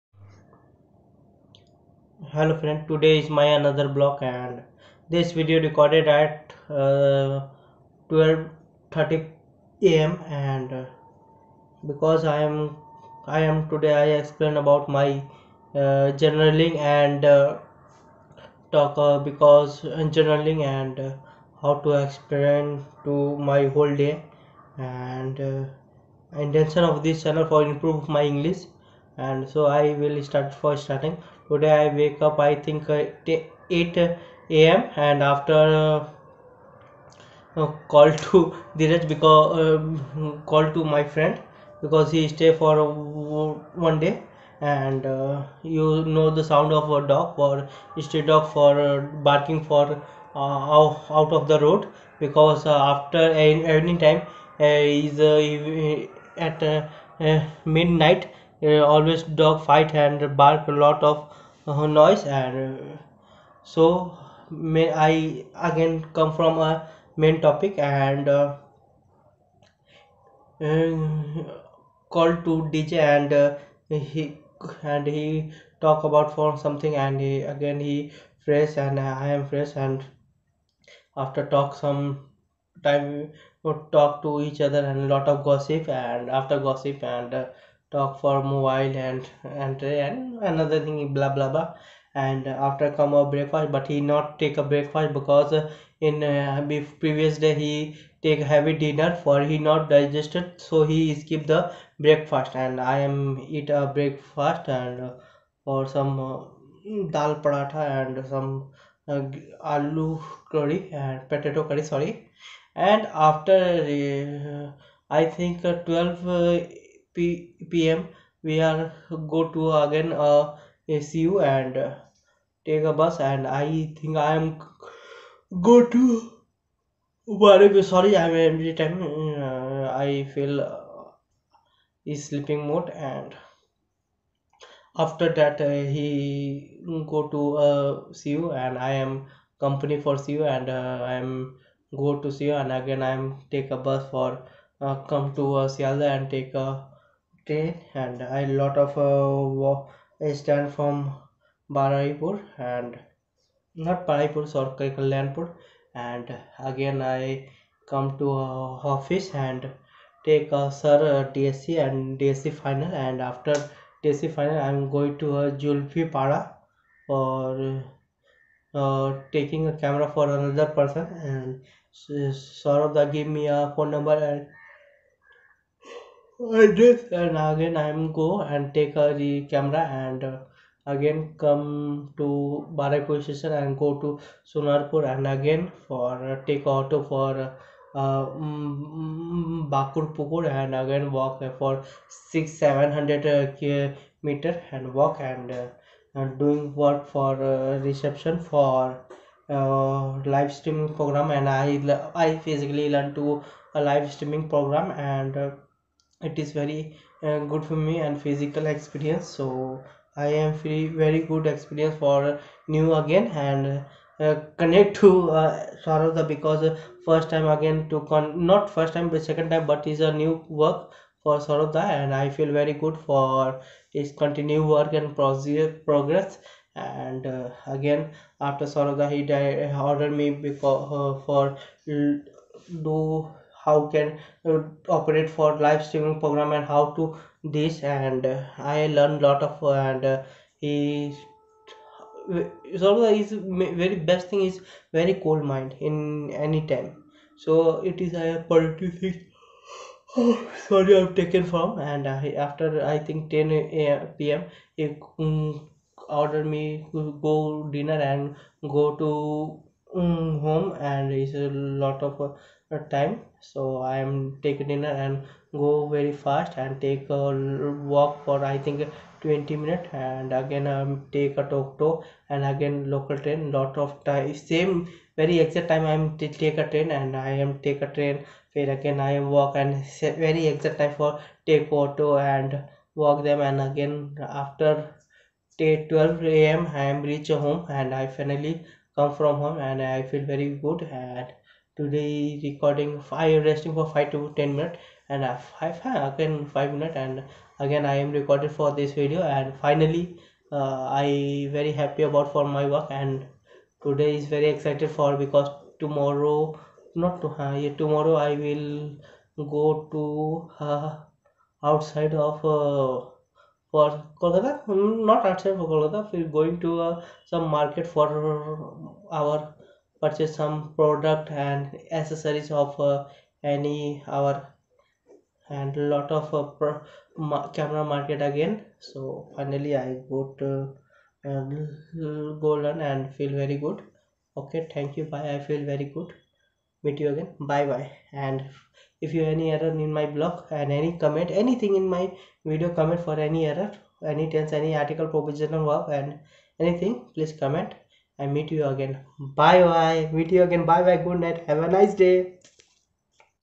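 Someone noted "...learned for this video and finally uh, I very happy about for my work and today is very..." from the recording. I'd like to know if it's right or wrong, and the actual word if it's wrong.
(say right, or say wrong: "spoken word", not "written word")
wrong: "recorded", not "learned".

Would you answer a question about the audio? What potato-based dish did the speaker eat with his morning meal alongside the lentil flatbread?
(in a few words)
aloo curry.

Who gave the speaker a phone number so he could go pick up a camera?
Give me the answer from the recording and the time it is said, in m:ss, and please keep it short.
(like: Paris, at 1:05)
Saurabh, at 2:51.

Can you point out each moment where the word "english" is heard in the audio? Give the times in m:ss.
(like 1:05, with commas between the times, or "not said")
0:28.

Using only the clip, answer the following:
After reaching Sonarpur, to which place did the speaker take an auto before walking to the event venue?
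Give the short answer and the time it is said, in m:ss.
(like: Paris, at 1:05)
Bakur Pukur, at 3:09.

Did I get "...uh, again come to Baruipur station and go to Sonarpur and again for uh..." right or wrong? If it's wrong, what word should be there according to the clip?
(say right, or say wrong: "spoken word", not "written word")
right.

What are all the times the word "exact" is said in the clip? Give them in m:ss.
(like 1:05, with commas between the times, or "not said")
4:35, 4:40.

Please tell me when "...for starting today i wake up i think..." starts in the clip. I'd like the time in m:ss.
0:30.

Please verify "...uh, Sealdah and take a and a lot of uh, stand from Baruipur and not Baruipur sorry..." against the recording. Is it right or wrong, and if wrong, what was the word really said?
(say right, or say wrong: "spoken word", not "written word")
right.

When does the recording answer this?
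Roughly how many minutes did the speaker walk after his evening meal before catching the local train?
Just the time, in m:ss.
4:29.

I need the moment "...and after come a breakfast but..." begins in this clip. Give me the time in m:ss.
1:32.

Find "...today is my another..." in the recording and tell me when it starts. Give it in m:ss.
0:02.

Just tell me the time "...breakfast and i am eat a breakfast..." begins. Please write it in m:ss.
1:41.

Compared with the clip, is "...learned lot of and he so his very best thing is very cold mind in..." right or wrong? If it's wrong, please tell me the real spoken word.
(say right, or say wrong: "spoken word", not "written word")
right.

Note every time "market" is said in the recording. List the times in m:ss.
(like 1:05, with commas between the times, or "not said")
5:17, 5:27.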